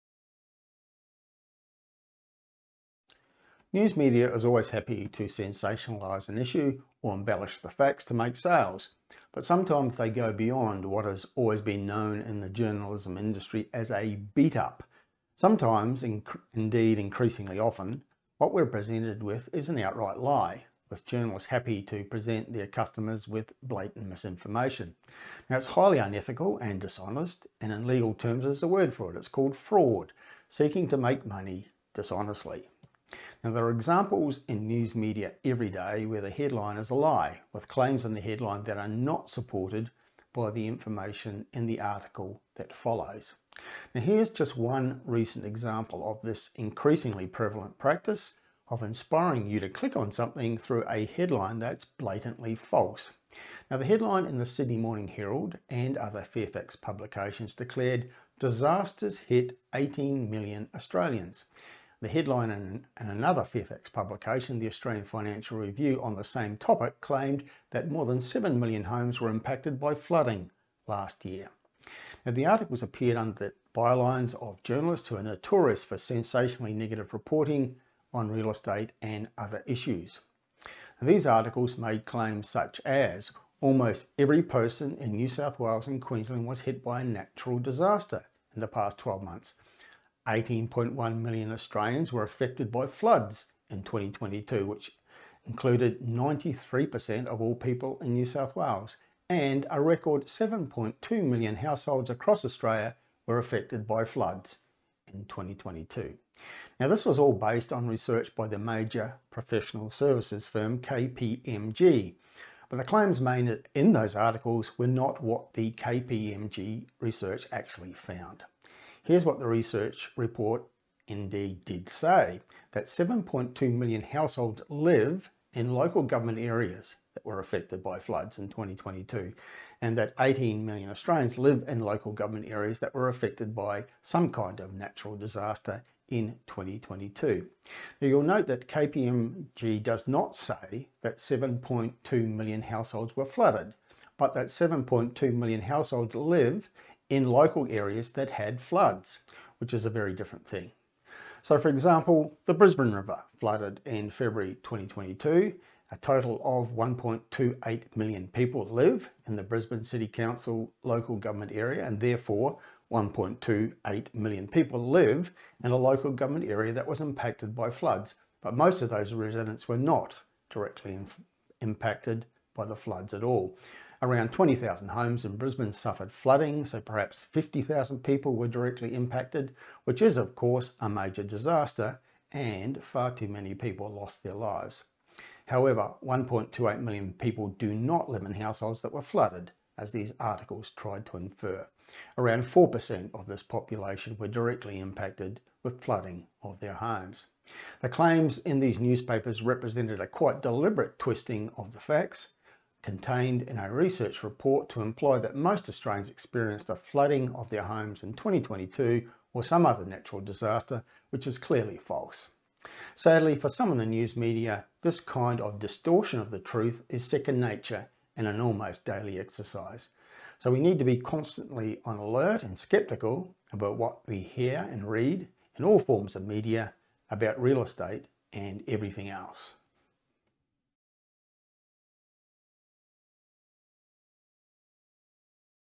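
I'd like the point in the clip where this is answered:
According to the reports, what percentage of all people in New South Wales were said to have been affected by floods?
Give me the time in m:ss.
1:36.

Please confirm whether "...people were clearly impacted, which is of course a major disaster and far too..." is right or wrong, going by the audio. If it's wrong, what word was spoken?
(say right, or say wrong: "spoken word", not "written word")
wrong: "directly", not "clearly".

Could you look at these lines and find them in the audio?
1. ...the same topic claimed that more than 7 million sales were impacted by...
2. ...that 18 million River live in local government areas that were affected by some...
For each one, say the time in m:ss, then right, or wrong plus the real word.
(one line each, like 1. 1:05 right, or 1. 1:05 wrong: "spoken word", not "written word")
1. 1:06 wrong: "homes", not "sales"
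2. 2:09 wrong: "Australians", not "River".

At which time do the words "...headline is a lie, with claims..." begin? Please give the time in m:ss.
0:36.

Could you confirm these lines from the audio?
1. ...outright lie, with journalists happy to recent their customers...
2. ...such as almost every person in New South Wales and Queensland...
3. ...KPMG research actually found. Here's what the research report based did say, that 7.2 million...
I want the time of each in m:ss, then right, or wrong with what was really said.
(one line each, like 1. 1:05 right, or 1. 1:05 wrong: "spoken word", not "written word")
1. 0:19 wrong: "present", not "recent"
2. 1:22 right
3. 1:55 wrong: "indeed", not "based".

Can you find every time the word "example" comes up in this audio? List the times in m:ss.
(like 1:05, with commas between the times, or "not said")
0:33, 0:45, 2:31.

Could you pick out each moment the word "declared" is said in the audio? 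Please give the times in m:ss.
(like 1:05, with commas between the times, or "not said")
0:57.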